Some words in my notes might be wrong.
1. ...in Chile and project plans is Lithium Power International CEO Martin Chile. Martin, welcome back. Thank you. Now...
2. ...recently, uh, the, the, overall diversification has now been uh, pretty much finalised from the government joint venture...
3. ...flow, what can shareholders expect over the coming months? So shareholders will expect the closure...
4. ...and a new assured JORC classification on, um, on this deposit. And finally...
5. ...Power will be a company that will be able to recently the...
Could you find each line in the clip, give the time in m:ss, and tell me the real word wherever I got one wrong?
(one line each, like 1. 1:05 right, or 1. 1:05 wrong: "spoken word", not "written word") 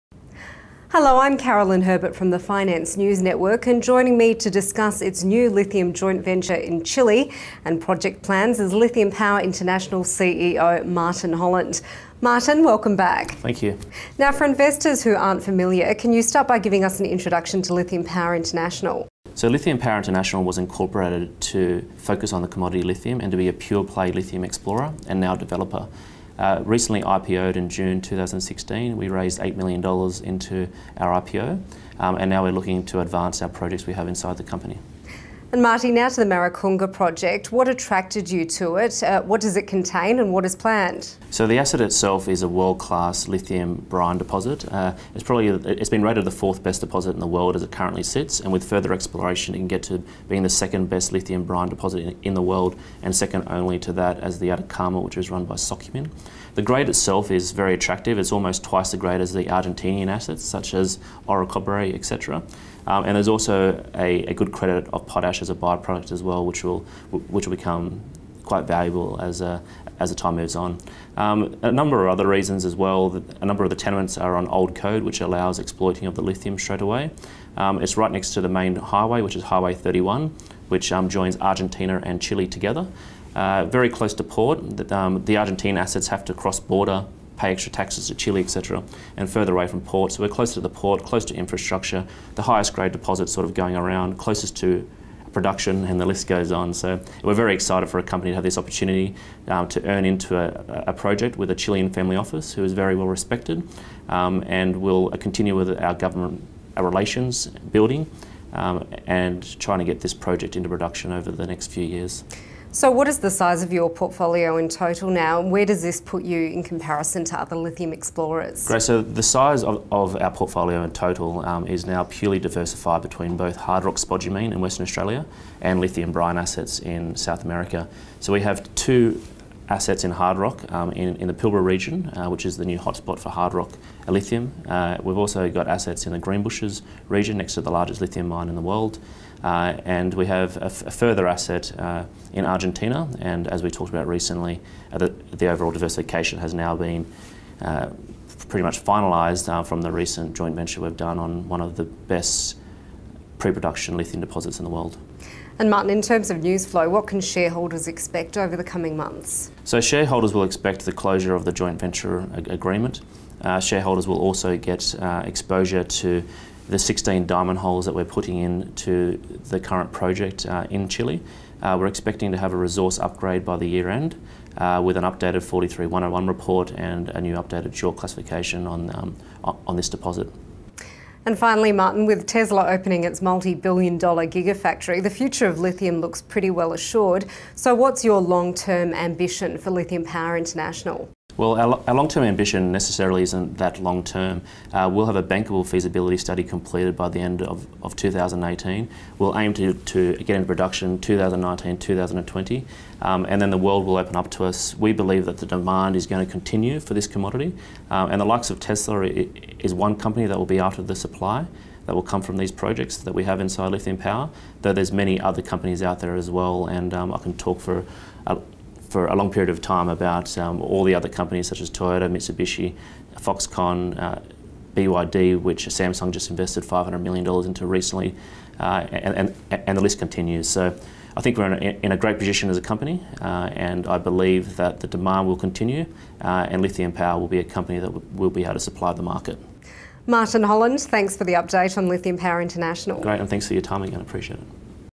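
1. 0:06 wrong: "Holland", not "Chile"
2. 2:24 wrong: "recent", not "government"
3. 2:36 right
4. 2:56 wrong: "updated", not "assured"
5. 3:56 wrong: "supply", not "recently".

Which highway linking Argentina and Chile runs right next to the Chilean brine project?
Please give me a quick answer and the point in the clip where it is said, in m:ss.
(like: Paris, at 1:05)
Highway 31, at 1:19.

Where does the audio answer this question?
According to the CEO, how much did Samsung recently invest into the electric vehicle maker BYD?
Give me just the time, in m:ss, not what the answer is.
3:46.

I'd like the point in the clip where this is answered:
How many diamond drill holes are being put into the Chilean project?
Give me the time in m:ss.
2:46.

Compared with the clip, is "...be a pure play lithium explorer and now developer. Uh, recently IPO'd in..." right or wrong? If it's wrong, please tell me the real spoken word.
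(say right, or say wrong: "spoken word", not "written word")
right.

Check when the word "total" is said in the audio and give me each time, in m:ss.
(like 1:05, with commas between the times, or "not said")
1:54, 2:00.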